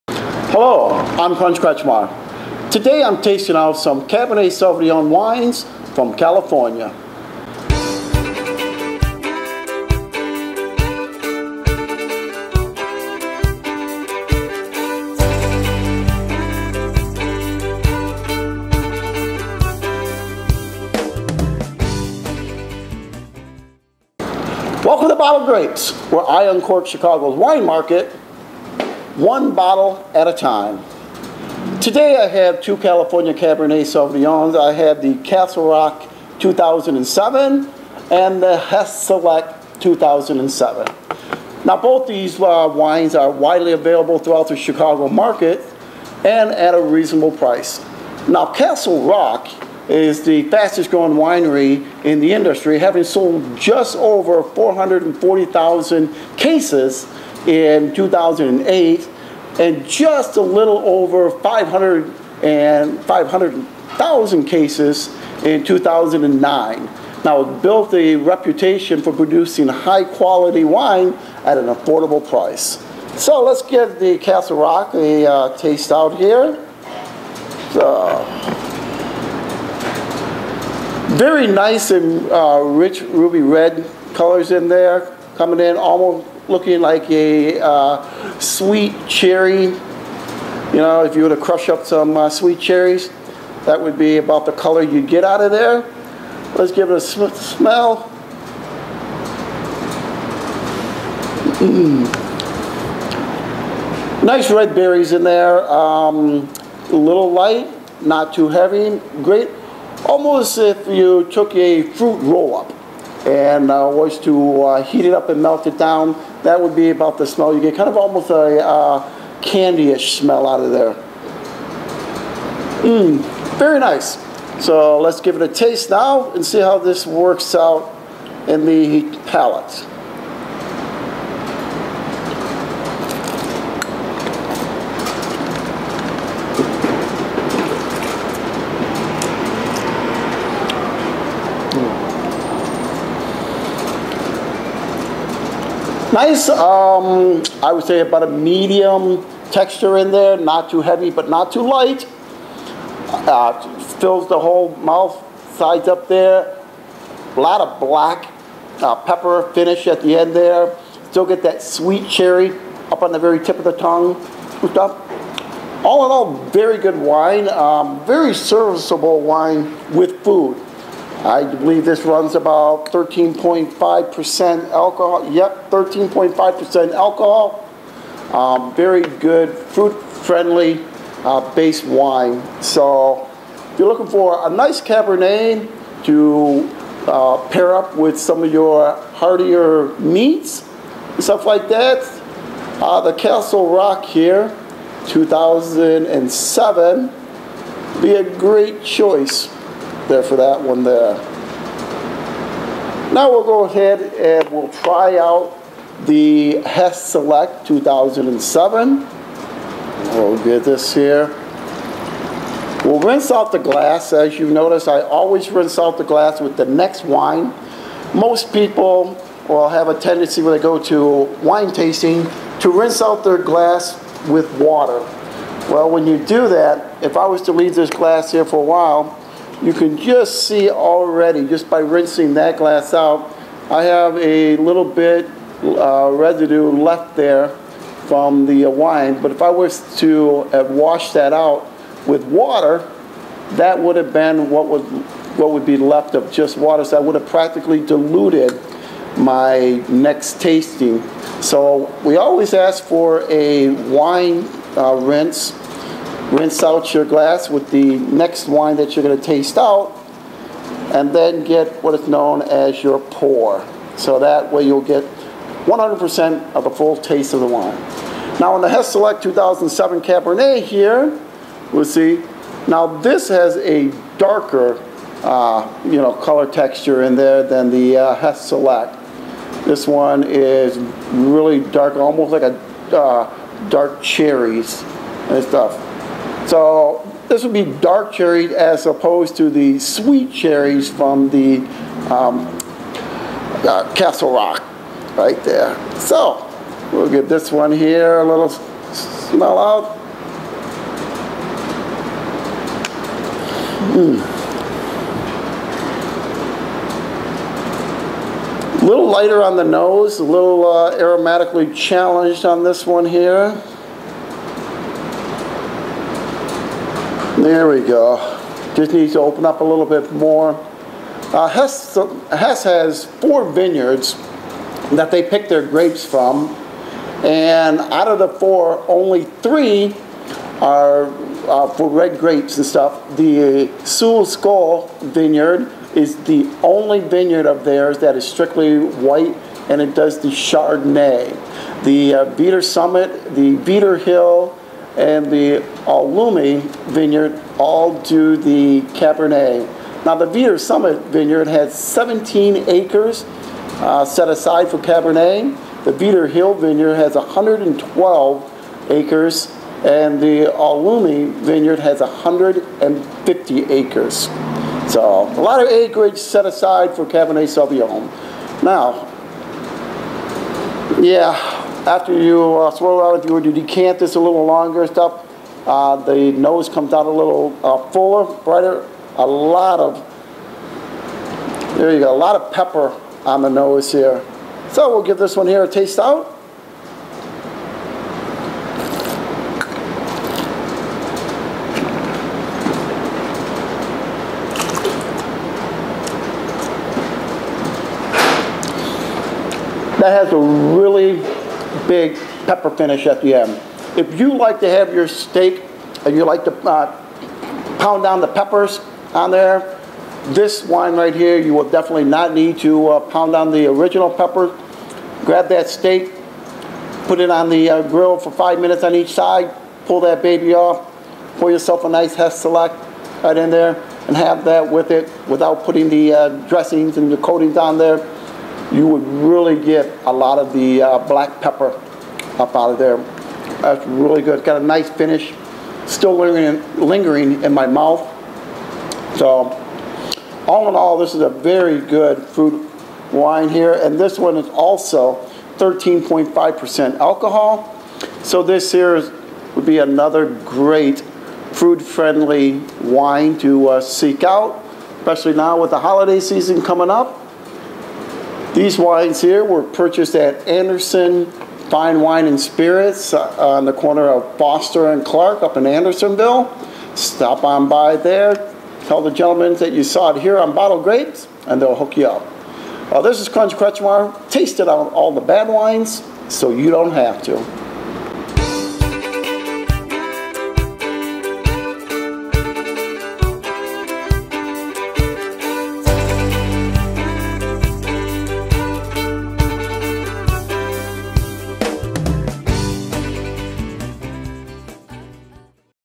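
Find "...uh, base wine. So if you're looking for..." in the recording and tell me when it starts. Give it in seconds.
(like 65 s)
181 s.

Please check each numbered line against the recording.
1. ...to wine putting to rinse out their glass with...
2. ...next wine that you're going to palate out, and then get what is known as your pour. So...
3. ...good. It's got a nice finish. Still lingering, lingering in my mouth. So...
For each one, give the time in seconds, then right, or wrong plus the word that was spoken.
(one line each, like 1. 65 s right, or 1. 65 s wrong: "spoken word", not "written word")
1. 220 s wrong: "tasting", not "putting"
2. 257 s wrong: "taste", not "palate"
3. 434 s right.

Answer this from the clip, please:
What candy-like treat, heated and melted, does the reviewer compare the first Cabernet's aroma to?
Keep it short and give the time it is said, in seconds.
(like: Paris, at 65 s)
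fruit roll-up, at 111 s.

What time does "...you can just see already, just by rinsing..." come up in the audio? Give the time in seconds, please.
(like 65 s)
229 s.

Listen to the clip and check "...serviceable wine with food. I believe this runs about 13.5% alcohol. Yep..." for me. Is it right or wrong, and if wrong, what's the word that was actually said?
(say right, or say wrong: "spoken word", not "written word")
right.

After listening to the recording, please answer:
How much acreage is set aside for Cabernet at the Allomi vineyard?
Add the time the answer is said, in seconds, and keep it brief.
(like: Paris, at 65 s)
150 acres, at 362 s.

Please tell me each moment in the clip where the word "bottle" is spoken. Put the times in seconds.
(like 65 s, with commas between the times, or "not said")
25 s, 29 s, 470 s.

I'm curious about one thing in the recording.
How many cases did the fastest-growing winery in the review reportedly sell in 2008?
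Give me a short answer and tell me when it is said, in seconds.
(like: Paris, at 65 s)
just over 440,000, at 53 s.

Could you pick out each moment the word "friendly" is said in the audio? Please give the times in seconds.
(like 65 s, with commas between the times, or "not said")
179 s, 451 s.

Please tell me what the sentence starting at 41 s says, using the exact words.
Now both these uh, wines are widely available throughout the Chicago market and at a reasonable price.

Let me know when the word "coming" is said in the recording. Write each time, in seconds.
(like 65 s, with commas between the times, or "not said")
85 s, 456 s.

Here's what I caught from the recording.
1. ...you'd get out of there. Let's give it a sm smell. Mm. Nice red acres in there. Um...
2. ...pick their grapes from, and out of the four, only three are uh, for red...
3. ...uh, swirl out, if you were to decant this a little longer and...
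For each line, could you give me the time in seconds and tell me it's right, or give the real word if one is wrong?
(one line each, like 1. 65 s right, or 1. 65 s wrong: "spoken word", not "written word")
1. 94 s wrong: "berries", not "acres"
2. 325 s right
3. 372 s right.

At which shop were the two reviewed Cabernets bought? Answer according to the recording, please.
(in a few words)
Anderson Fine Wine and Spirits.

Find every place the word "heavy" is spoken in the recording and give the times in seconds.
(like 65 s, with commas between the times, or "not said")
108 s, 150 s.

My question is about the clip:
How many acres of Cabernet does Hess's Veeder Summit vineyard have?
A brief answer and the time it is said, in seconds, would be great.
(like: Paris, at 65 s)
17, at 351 s.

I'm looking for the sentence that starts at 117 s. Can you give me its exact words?
You get kind of almost a uh, candyish smell out of there.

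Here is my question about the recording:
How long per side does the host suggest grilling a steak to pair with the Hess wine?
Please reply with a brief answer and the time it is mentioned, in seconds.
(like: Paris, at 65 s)
five minutes, at 418 s.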